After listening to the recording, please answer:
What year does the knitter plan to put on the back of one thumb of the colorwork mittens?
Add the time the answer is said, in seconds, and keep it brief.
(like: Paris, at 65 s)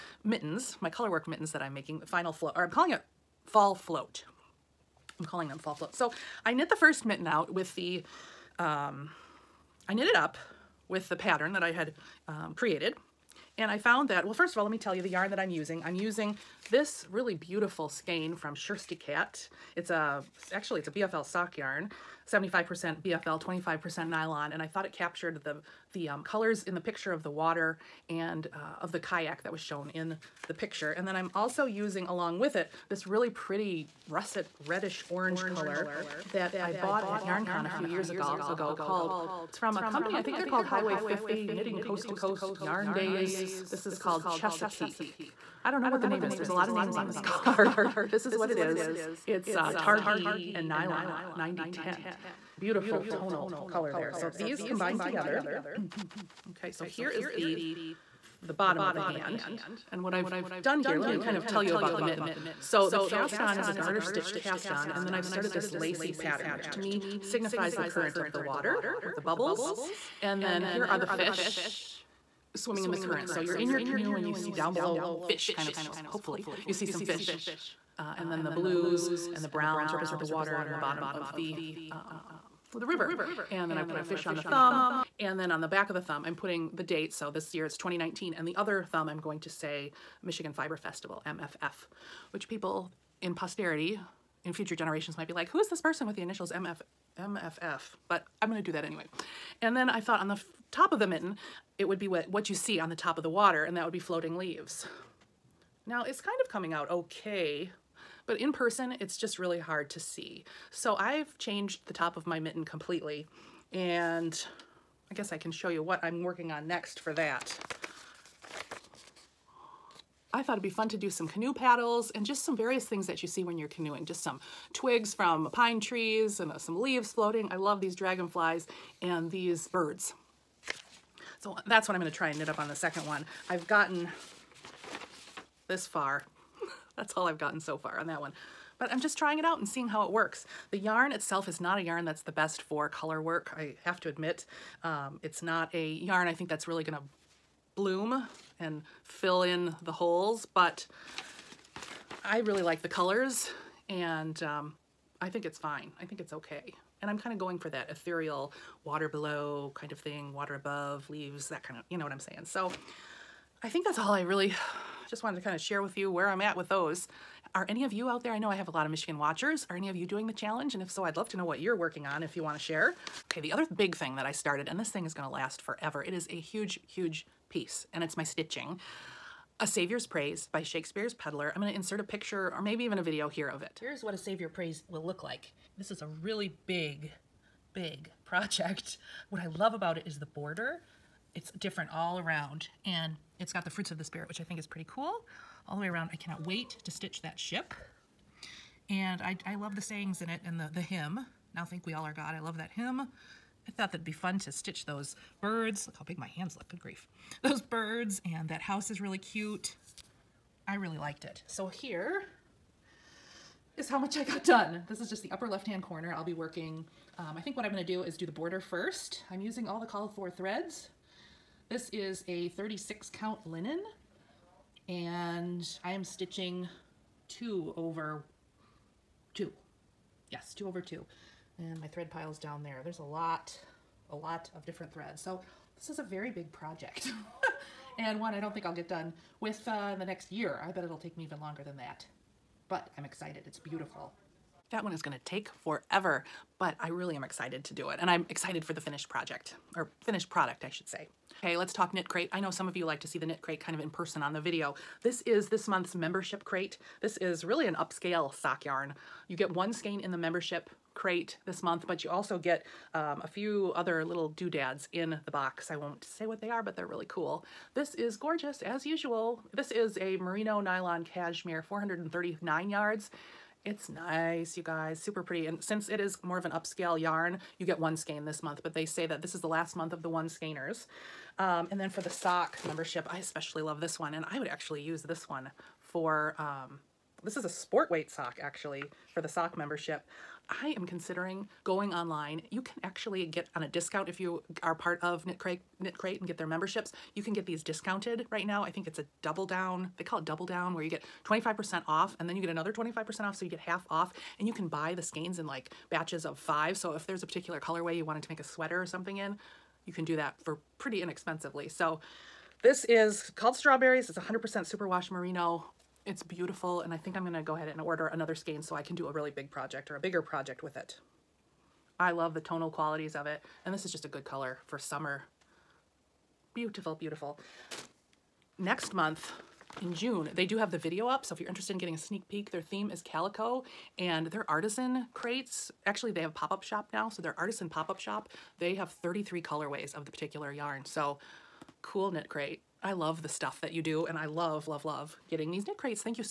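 2019, at 87 s.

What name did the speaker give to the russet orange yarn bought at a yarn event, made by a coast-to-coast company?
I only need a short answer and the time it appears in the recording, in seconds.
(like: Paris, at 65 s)
Chesapeake, at 44 s.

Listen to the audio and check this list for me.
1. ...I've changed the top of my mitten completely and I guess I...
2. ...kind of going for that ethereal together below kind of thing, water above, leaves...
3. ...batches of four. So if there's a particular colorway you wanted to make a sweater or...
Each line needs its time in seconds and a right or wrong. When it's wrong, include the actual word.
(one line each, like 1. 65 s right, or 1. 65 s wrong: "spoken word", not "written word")
1. 110 s right
2. 157 s wrong: "water", not "together"
3. 305 s wrong: "five", not "four".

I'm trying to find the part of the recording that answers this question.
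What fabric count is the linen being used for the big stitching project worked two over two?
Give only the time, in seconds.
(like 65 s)
222 s.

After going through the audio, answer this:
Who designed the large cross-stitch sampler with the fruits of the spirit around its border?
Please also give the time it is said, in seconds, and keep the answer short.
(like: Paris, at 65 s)
Shakespeare's Peddler, at 180 s.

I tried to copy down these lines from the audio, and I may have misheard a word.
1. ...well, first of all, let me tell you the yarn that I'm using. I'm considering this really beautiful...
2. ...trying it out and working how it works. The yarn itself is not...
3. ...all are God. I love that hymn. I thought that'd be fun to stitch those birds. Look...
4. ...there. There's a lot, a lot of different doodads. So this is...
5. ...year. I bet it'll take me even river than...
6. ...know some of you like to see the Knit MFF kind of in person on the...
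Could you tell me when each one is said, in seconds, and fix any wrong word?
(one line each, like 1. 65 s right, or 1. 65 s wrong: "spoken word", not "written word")
1. 14 s wrong: "using", not "considering"
2. 139 s wrong: "seeing", not "working"
3. 201 s right
4. 232 s wrong: "threads", not "doodads"
5. 240 s wrong: "longer", not "river"
6. 252 s wrong: "Crate", not "MFF".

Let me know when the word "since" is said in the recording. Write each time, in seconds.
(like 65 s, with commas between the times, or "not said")
275 s.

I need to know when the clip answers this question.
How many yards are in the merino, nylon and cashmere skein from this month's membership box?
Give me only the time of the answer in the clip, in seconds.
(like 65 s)
271 s.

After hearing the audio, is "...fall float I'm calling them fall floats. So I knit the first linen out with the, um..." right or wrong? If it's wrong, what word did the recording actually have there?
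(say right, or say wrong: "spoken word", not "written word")
wrong: "mitten", not "linen".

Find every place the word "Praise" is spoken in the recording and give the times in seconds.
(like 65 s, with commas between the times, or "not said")
180 s, 184 s.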